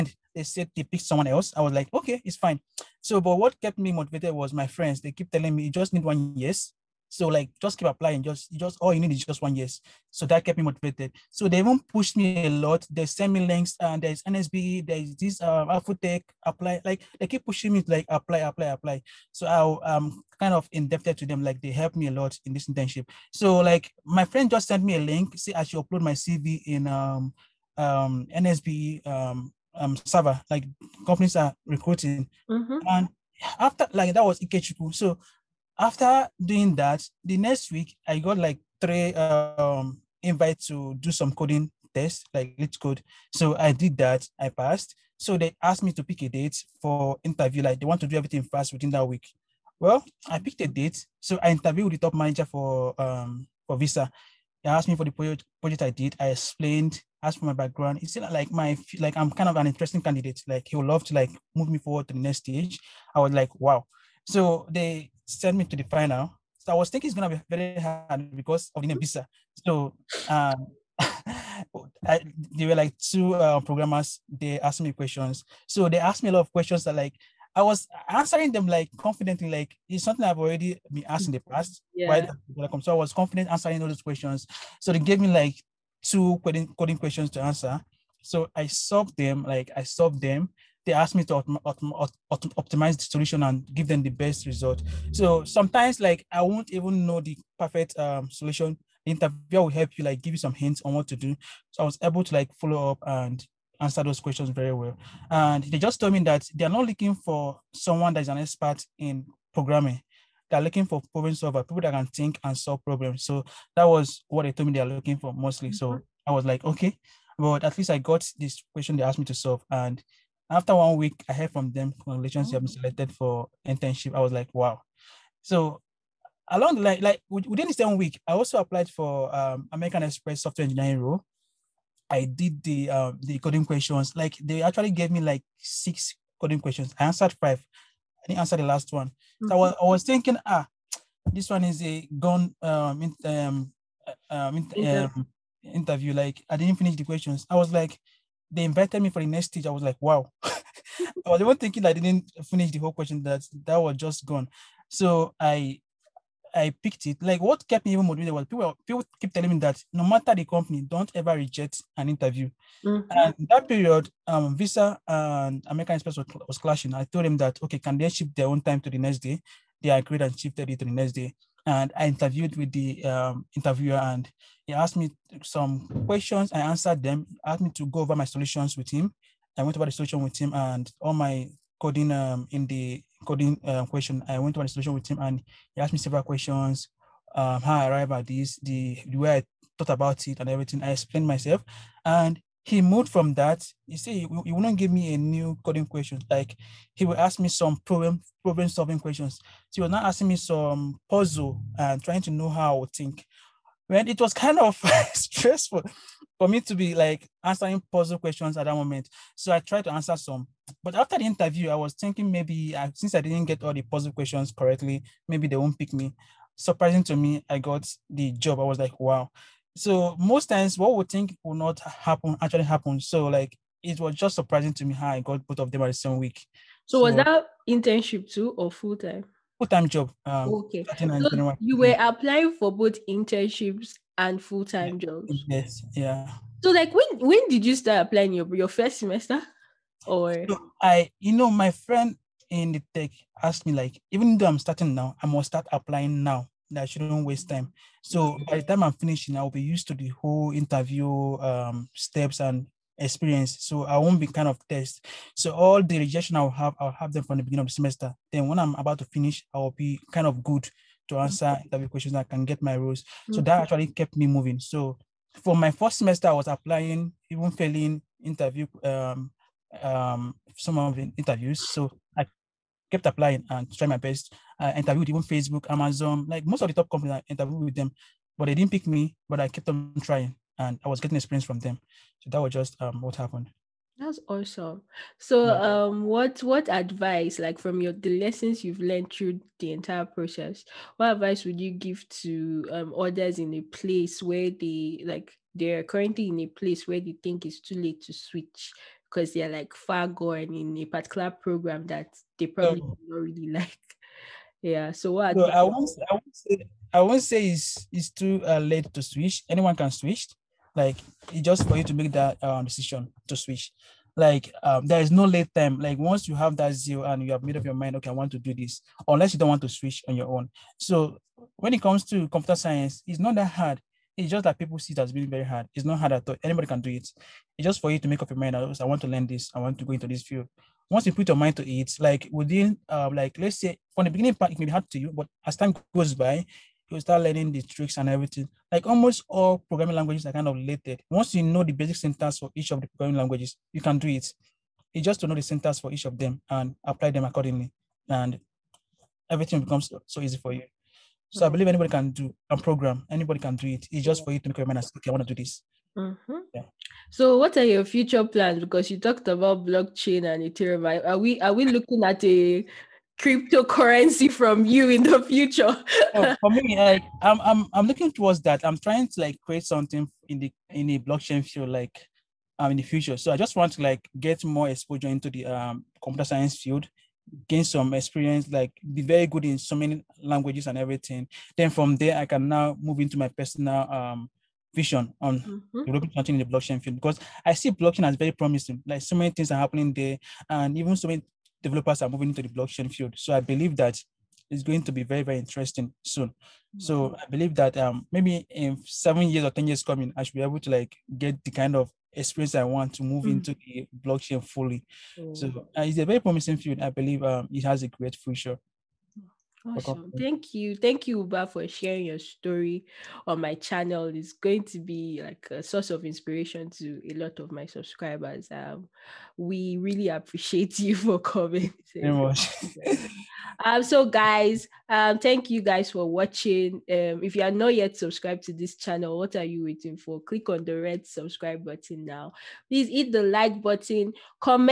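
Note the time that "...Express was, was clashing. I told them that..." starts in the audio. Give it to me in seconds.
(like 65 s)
165 s.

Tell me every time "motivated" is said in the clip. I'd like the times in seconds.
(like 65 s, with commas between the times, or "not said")
3 s, 10 s, 158 s.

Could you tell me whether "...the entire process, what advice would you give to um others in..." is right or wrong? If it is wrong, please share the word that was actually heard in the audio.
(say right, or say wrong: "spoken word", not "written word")
right.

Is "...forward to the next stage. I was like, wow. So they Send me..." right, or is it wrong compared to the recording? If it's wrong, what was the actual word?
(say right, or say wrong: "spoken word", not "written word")
right.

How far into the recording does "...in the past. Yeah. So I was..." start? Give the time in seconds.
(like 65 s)
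81 s.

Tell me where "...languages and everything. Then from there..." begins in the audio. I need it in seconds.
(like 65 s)
380 s.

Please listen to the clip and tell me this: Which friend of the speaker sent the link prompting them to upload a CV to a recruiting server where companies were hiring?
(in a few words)
Ikechukwu.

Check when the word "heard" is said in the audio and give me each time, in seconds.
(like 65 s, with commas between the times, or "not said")
121 s.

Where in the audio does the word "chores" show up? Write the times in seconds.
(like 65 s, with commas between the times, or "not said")
not said.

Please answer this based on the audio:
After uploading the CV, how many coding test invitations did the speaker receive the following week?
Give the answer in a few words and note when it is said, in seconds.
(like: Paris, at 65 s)
3, at 38 s.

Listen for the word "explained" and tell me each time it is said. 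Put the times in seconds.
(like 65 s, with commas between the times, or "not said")
56 s, 190 s.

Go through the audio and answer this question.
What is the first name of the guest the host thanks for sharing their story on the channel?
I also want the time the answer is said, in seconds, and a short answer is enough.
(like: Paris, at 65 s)
Ubah, at 411 s.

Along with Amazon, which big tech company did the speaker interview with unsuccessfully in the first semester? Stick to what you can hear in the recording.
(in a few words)
Facebook.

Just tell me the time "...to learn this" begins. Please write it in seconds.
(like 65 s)
329 s.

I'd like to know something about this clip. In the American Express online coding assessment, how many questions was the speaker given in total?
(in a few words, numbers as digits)
6.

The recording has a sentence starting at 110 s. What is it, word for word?
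They're looking for problem solver, people that can think and solve problems.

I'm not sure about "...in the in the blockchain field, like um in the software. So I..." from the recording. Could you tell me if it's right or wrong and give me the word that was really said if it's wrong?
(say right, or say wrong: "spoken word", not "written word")
wrong: "future", not "software".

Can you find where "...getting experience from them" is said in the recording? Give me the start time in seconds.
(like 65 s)
280 s.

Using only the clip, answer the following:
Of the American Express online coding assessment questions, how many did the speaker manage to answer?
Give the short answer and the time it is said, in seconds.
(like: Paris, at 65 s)
5, at 137 s.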